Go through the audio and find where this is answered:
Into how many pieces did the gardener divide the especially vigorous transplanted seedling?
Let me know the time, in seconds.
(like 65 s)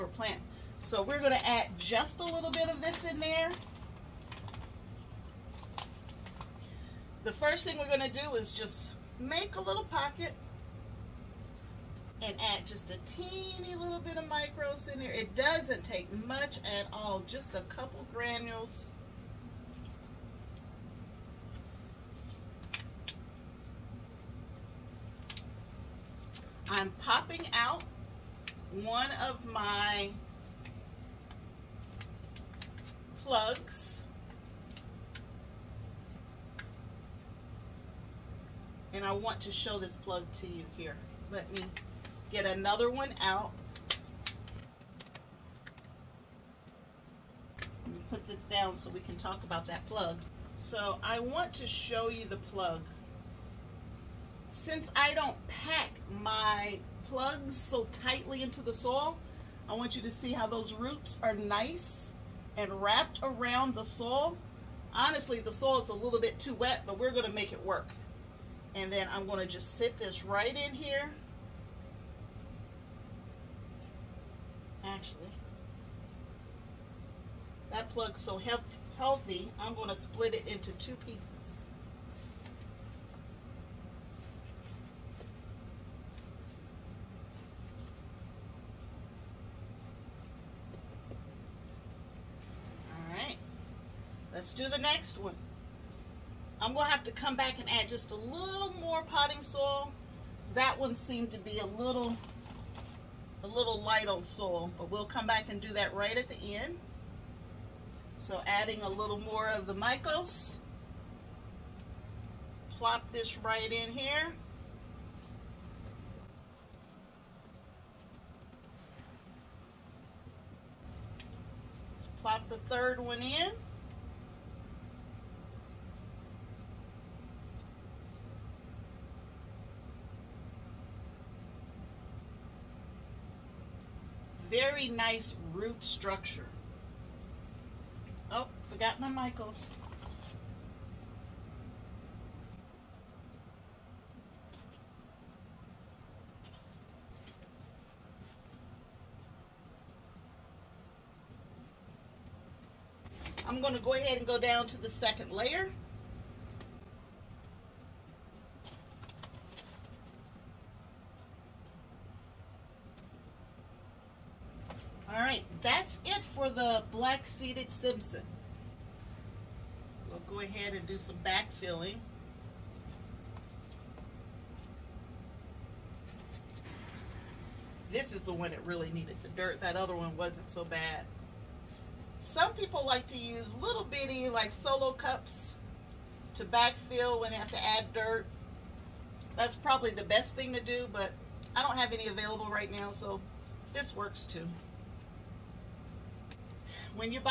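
80 s.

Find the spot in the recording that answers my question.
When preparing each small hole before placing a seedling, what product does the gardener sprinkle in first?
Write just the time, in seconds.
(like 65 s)
14 s.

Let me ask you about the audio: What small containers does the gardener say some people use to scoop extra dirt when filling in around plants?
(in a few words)
Solo cups.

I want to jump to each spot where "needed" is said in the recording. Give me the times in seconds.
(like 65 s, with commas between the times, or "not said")
178 s.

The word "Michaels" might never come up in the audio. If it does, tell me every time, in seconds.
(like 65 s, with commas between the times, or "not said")
109 s, 139 s.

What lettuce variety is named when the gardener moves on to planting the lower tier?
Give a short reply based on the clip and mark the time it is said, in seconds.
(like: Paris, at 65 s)
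Black-seeded Simpson, at 167 s.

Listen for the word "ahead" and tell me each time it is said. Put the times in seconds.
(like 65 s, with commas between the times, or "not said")
153 s, 170 s.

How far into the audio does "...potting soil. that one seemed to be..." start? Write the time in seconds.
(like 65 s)
99 s.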